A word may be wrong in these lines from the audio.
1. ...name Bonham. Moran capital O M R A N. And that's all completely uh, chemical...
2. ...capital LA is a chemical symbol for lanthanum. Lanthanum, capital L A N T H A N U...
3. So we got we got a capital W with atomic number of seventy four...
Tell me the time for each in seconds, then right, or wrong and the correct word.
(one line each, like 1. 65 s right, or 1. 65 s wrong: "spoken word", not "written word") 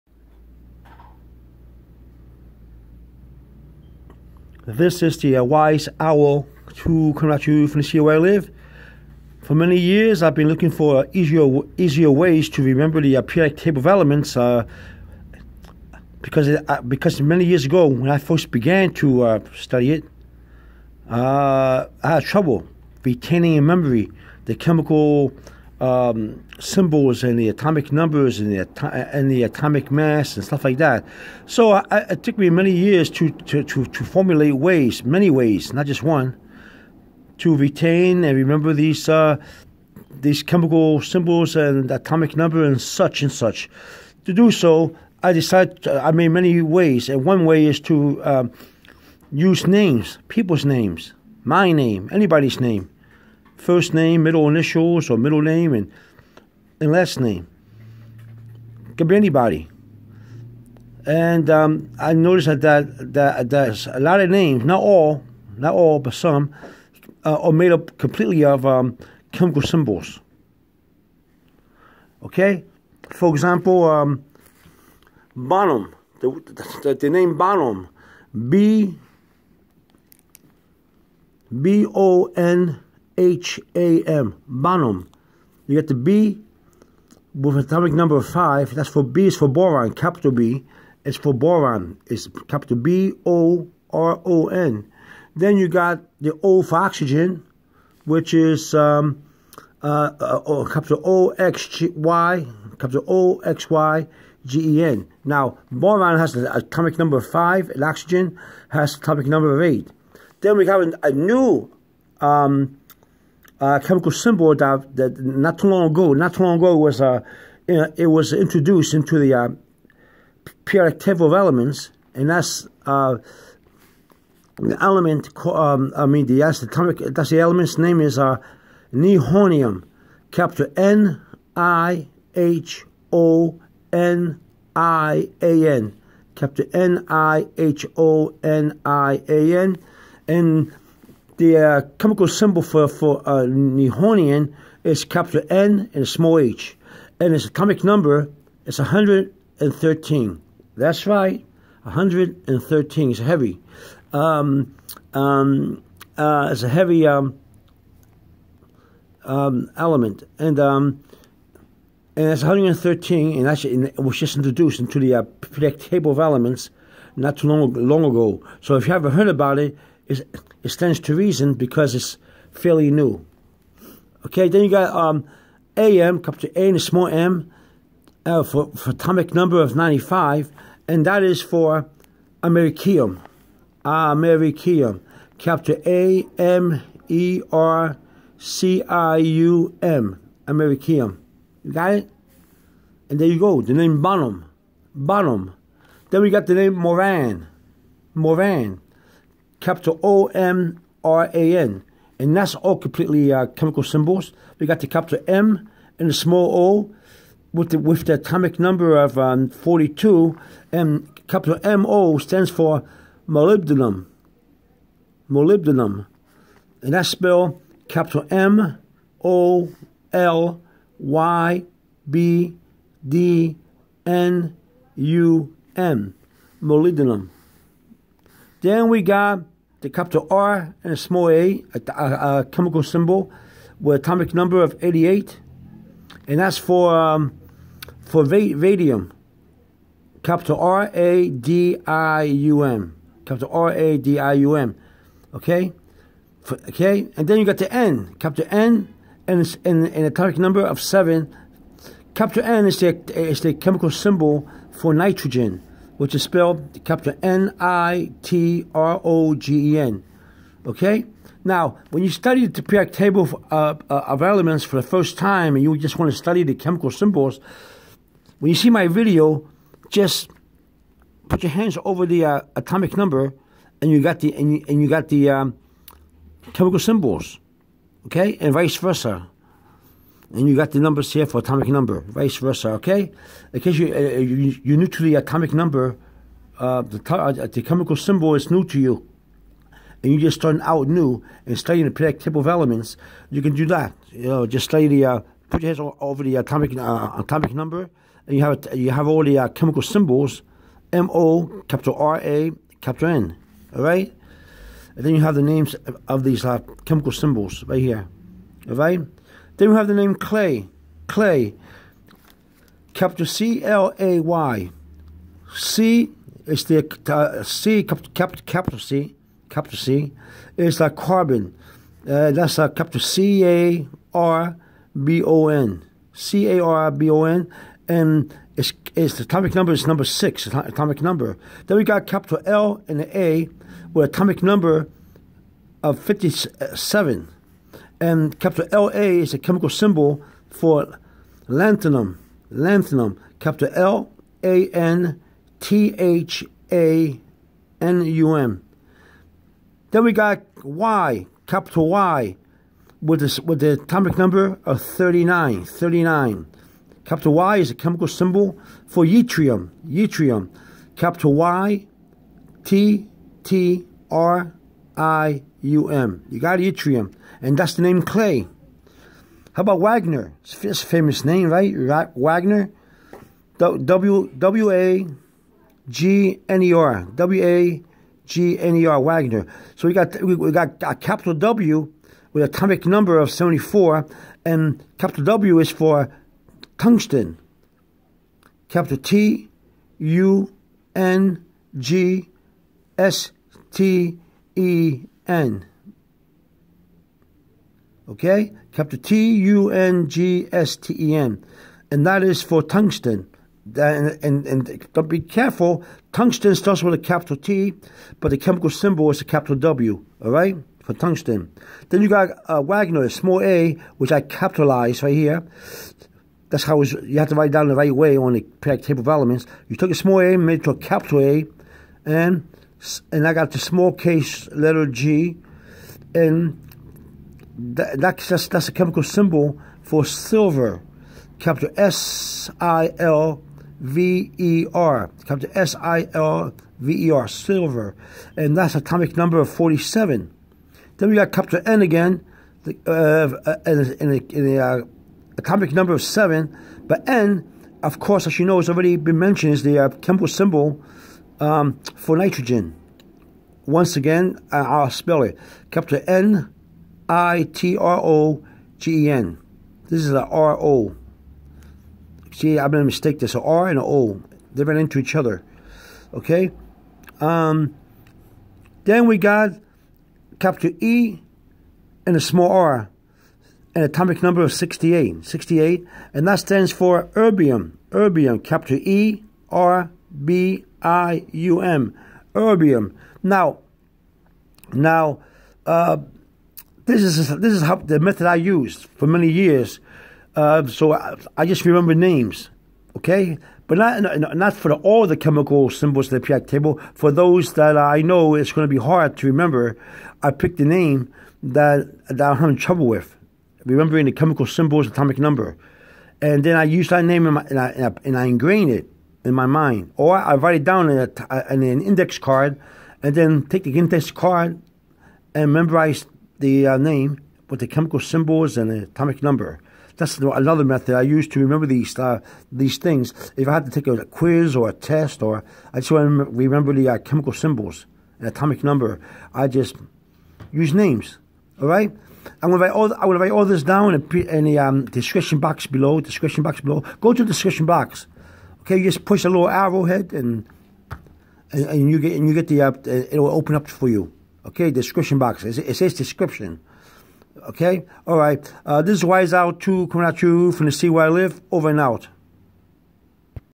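1. 196 s wrong: "Moran", not "Bonham"
2. 338 s right
3. 379 s right.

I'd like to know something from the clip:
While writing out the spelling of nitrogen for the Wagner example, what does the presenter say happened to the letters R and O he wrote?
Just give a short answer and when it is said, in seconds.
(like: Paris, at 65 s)
They ran into each other, at 464 s.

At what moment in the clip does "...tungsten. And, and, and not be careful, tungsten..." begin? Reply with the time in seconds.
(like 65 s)
402 s.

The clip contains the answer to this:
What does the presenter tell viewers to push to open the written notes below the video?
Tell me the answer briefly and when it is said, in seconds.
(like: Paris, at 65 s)
a little arrowhead, at 539 s.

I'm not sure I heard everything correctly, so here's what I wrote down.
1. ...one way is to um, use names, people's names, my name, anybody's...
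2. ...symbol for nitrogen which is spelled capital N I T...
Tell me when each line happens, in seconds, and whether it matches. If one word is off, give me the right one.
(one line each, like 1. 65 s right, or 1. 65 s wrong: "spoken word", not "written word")
1. 47 s right
2. 253 s right.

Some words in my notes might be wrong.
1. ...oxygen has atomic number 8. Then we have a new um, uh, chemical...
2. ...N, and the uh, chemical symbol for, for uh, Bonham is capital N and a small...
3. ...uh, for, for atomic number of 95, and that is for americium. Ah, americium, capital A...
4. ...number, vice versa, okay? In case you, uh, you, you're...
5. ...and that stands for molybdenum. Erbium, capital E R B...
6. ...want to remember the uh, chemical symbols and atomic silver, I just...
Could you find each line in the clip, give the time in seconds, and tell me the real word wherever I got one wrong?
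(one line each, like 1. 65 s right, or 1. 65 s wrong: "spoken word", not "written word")
1. 107 s right
2. 139 s wrong: "Nihonian", not "Bonham"
3. 178 s right
4. 281 s right
5. 476 s wrong: "erbium", not "molybdenum"
6. 525 s wrong: "number", not "silver".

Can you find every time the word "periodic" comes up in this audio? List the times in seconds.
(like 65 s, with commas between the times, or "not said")
13 s, 165 s, 262 s, 291 s, 418 s, 496 s.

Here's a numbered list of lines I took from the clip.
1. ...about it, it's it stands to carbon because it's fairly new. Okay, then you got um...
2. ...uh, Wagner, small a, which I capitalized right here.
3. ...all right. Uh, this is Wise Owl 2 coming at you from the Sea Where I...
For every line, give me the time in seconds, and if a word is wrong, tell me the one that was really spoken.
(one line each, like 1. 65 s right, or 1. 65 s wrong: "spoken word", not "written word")
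1. 169 s wrong: "reason", not "carbon"
2. 412 s right
3. 548 s right.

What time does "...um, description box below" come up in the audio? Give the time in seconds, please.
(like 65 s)
534 s.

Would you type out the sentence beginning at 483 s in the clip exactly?
Now, now, uh, this is this is how the method I used for many years.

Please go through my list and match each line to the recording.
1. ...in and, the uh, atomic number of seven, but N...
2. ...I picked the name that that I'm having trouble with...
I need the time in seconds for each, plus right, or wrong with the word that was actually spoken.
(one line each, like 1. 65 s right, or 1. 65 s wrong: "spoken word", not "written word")
1. 443 s right
2. 500 s right.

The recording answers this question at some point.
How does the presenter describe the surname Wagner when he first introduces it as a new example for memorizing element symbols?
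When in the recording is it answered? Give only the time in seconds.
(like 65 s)
370 s.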